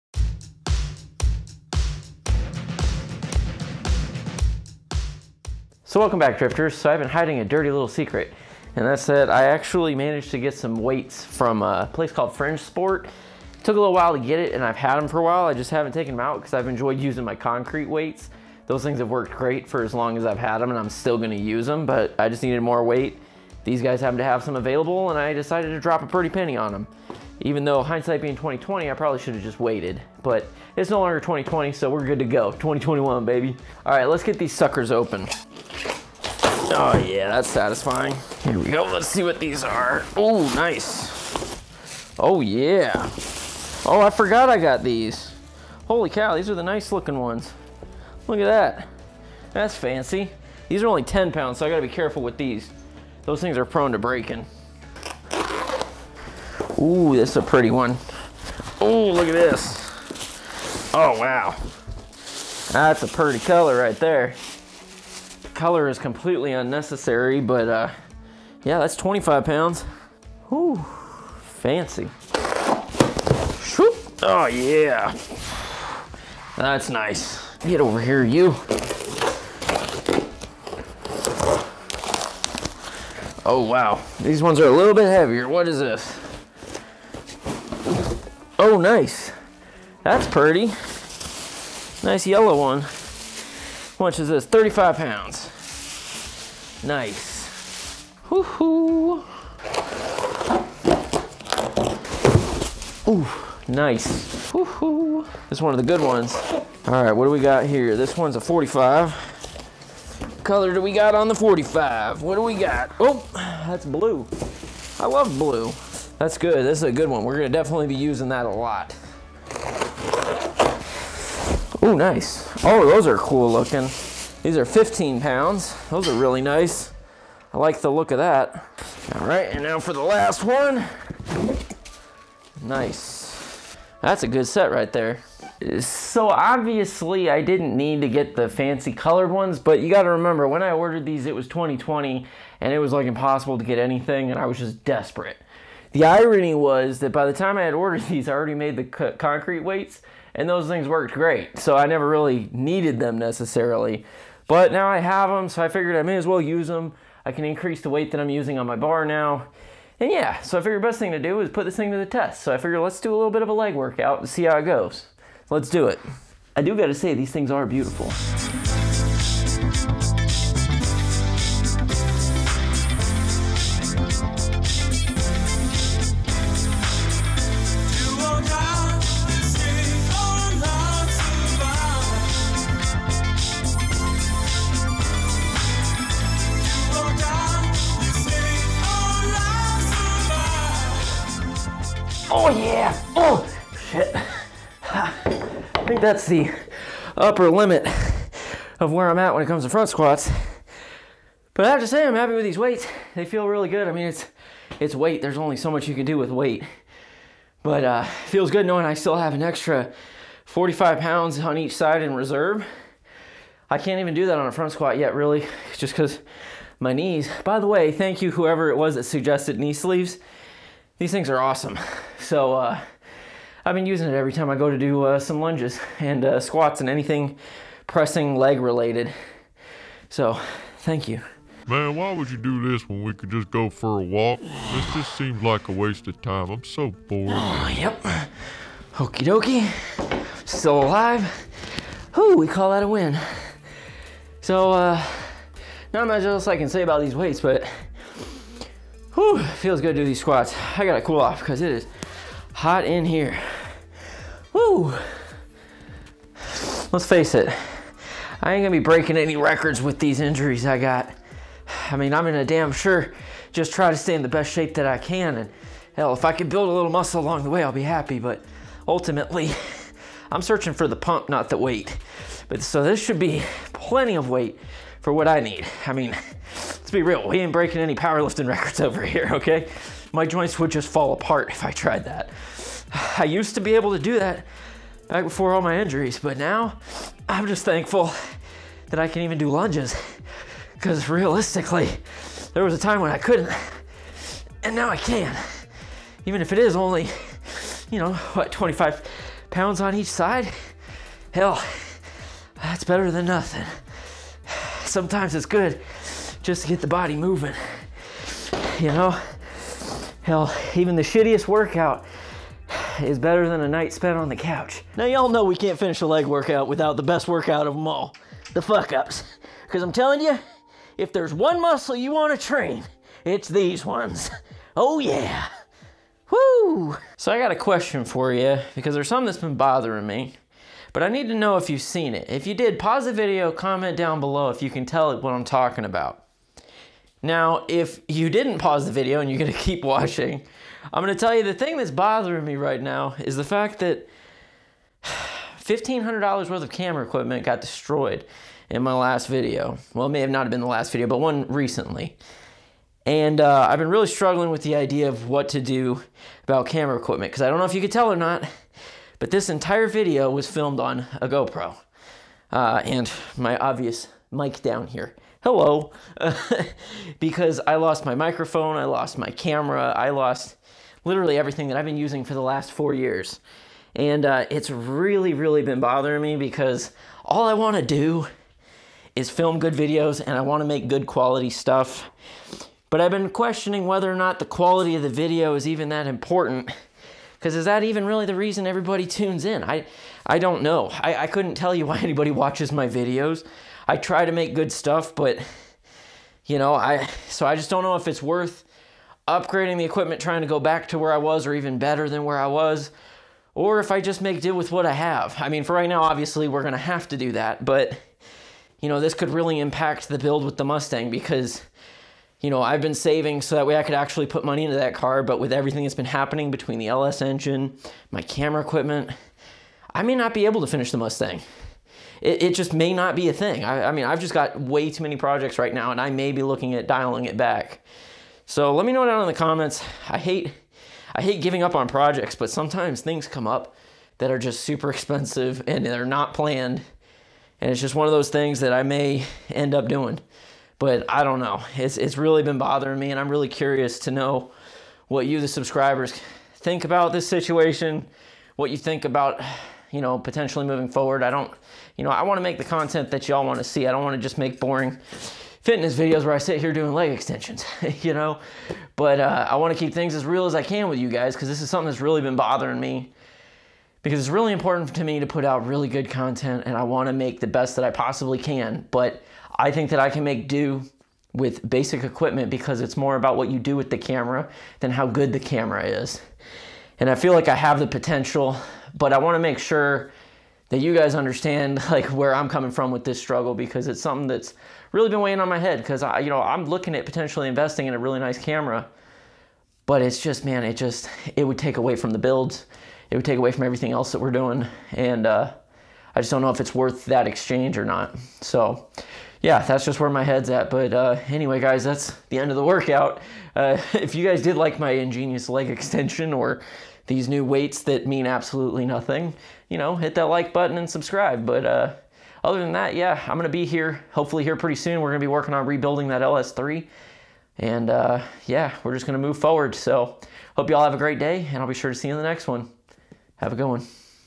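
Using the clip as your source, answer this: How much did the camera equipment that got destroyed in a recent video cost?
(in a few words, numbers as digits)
$1,500.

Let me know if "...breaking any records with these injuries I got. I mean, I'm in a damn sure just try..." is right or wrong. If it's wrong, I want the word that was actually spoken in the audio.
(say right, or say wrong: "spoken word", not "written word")
right.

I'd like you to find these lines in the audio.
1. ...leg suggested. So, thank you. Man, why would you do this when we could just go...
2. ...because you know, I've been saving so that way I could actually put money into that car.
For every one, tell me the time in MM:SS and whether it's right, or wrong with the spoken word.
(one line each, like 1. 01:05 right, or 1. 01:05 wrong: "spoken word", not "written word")
1. 03:48 wrong: "related", not "suggested"
2. 06:51 right.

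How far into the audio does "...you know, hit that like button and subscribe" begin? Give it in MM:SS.
08:29.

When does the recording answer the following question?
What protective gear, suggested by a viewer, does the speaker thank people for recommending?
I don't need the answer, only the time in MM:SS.
03:39.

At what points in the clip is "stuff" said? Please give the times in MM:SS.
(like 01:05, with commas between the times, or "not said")
06:21, 06:34.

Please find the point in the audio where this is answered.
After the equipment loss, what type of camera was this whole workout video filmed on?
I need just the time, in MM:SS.
06:01.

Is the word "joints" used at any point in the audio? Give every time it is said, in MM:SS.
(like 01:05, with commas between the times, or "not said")
04:40.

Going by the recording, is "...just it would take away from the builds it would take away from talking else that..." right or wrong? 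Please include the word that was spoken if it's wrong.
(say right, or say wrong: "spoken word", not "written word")
wrong: "everything", not "talking".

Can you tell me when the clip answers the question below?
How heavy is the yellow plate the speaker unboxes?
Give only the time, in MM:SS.
01:34.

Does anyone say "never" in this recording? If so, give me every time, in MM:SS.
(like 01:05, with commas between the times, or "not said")
02:31.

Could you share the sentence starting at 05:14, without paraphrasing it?
Now, y'all know we can't finish a leg workout without the best workout of them all the fuck ups.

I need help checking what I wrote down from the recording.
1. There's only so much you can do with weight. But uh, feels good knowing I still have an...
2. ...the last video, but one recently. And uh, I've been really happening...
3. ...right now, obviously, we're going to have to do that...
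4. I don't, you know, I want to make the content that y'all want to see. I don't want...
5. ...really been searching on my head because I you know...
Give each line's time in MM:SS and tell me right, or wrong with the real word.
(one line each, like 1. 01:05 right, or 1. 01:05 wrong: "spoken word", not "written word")
1. 03:25 right
2. 05:50 wrong: "struggling", not "happening"
3. 06:45 right
4. 07:31 right
5. 08:04 wrong: "weighing", not "searching".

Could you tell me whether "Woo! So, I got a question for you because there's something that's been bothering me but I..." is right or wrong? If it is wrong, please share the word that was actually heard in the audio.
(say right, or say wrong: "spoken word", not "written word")
right.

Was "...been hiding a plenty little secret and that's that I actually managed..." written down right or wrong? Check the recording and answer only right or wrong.
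wrong.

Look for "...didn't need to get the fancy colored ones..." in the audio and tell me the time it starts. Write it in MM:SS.
02:17.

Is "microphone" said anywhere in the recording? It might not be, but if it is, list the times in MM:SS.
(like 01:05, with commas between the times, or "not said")
06:08.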